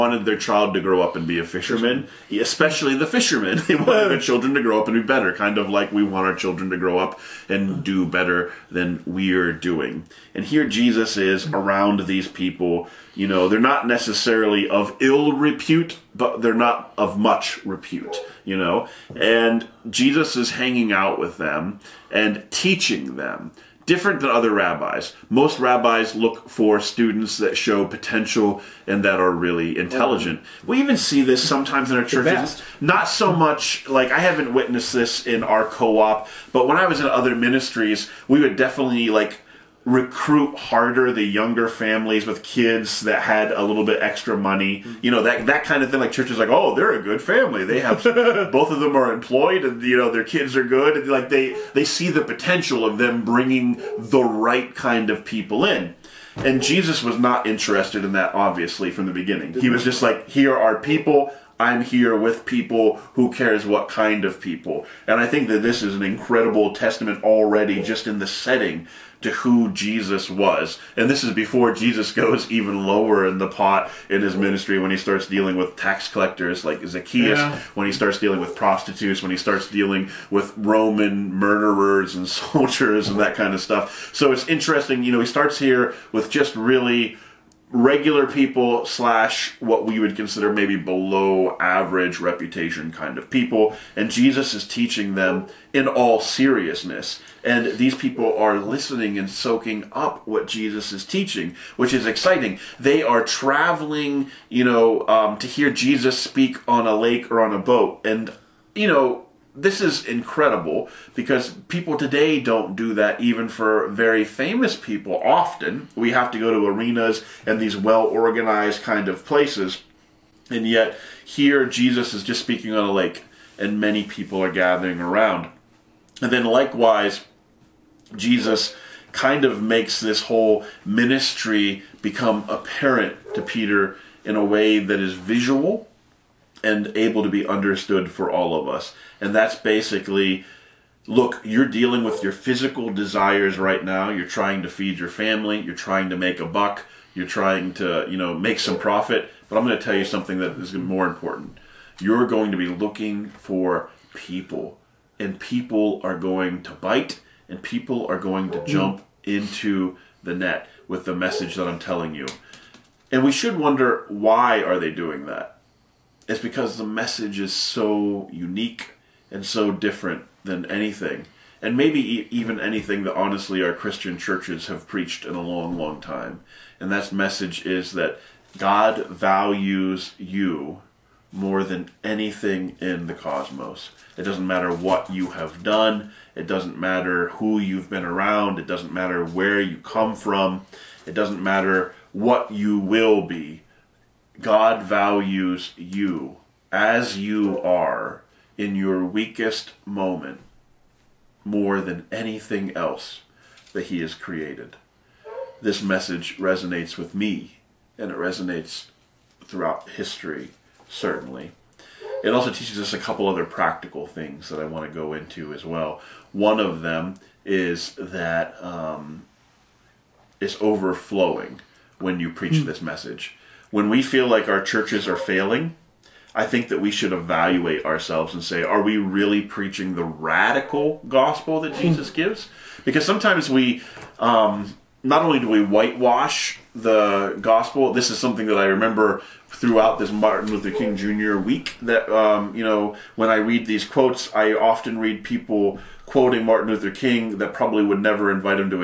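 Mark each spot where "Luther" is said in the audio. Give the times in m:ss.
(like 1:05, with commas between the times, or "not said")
4:00, 4:06.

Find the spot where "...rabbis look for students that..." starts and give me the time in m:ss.
0:25.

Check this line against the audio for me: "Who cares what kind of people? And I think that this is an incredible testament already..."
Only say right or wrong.
right.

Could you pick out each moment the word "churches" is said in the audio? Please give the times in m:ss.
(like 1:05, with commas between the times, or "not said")
0:32, 0:46, 2:54, 3:44.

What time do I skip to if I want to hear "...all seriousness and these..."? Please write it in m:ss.
1:35.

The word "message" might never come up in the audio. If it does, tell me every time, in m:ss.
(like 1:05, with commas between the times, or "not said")
2:41, 2:46, 2:57, 3:25, 3:42.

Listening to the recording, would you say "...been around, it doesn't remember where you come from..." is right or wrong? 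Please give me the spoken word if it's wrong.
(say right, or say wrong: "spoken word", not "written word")
wrong: "matter", not "remember".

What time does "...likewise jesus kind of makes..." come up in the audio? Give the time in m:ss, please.
2:06.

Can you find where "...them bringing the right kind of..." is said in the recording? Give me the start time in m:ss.
0:52.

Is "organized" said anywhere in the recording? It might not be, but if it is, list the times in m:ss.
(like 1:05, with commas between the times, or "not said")
1:58.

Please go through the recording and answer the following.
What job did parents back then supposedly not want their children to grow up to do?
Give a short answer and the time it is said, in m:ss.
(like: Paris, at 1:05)
fisherman, at 0:01.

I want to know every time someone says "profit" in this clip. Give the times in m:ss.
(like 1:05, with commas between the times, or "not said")
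2:28.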